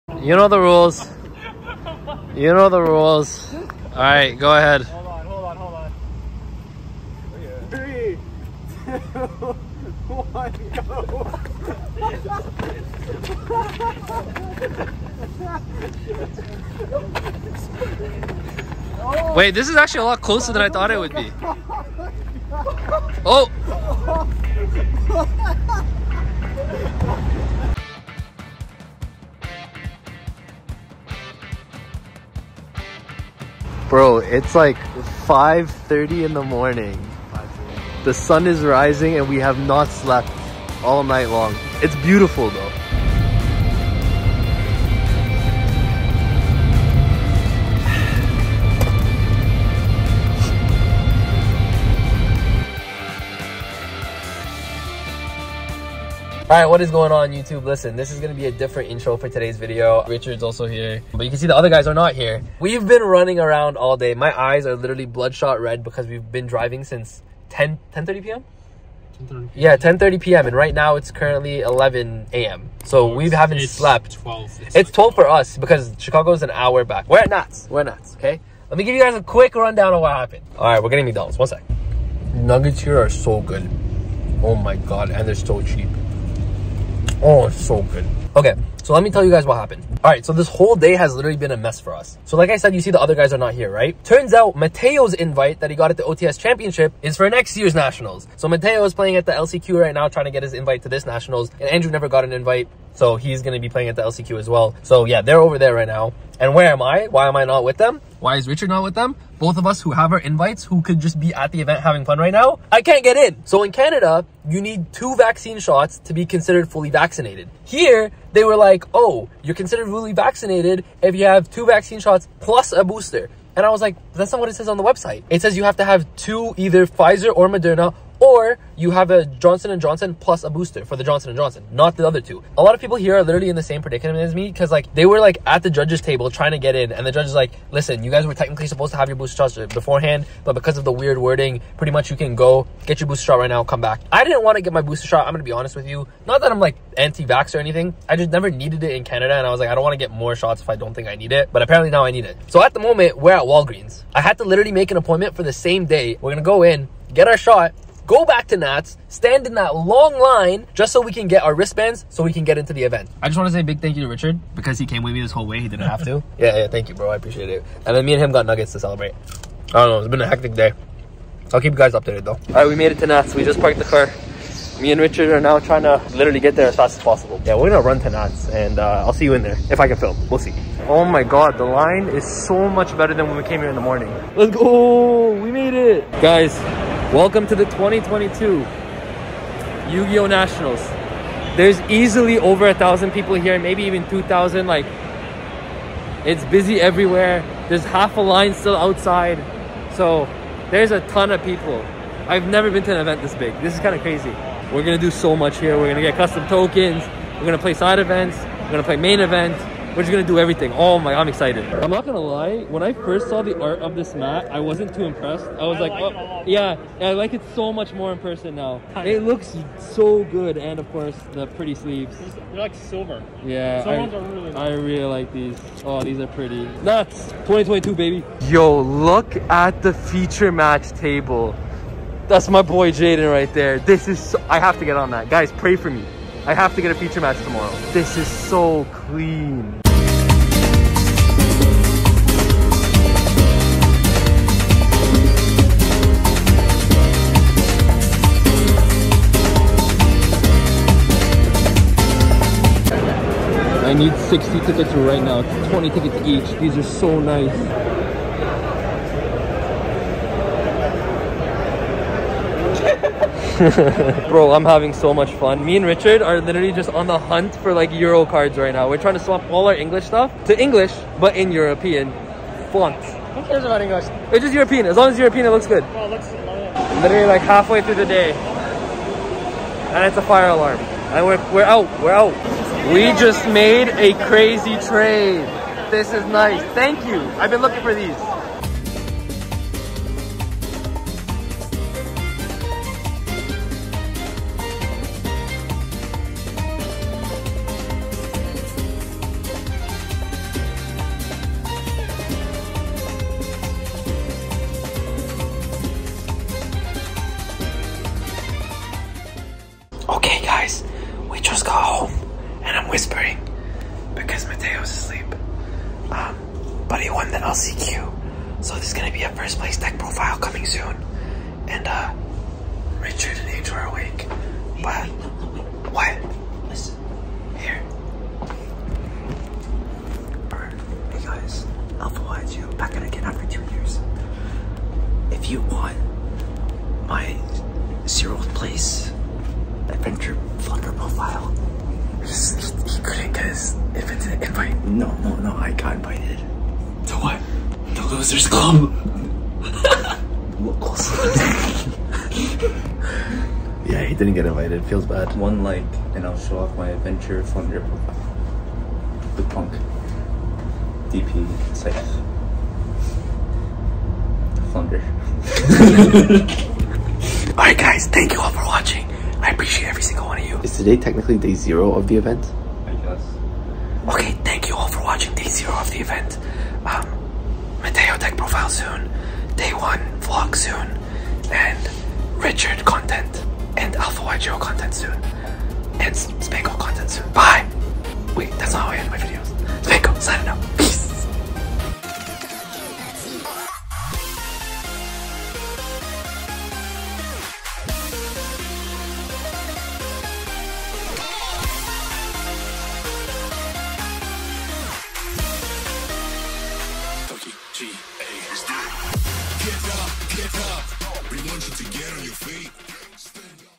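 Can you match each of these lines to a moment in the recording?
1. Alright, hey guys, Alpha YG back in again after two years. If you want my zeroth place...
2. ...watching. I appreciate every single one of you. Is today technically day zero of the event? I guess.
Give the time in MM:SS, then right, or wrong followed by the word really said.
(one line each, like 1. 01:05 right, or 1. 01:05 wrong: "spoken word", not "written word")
1. 05:30 right
2. 06:08 right.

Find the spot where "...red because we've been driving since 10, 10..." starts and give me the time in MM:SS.
01:05.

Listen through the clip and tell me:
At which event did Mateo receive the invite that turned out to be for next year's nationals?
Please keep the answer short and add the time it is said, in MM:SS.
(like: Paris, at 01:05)
OTS championship, at 01:36.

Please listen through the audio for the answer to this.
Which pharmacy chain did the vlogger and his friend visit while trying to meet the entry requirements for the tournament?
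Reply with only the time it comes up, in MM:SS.
02:33.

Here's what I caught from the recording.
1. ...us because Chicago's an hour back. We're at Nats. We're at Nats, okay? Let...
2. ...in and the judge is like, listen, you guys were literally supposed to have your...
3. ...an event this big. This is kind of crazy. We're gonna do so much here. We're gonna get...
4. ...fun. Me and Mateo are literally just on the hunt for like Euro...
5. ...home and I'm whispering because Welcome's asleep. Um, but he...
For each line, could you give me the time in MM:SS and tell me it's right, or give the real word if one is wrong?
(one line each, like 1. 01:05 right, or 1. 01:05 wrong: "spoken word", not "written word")
1. 01:15 right
2. 02:16 wrong: "technically", not "literally"
3. 03:22 right
4. 04:25 wrong: "Richard", not "Mateo"
5. 05:11 wrong: "Mateo", not "Welcome".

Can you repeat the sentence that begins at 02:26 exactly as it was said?
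Not that I'm like anti-vax or anything.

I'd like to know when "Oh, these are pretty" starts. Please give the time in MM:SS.
03:45.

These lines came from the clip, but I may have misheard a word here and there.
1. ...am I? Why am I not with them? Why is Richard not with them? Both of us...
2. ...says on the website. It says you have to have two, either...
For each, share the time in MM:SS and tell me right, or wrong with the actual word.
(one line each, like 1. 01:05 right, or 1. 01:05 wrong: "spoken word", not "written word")
1. 01:46 right
2. 02:04 right.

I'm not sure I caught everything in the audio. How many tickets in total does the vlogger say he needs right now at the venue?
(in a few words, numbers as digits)
60.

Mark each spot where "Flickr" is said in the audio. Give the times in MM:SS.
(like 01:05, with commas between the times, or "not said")
05:40, 05:57.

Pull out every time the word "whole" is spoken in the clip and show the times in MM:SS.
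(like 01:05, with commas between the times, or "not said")
01:30, 02:45.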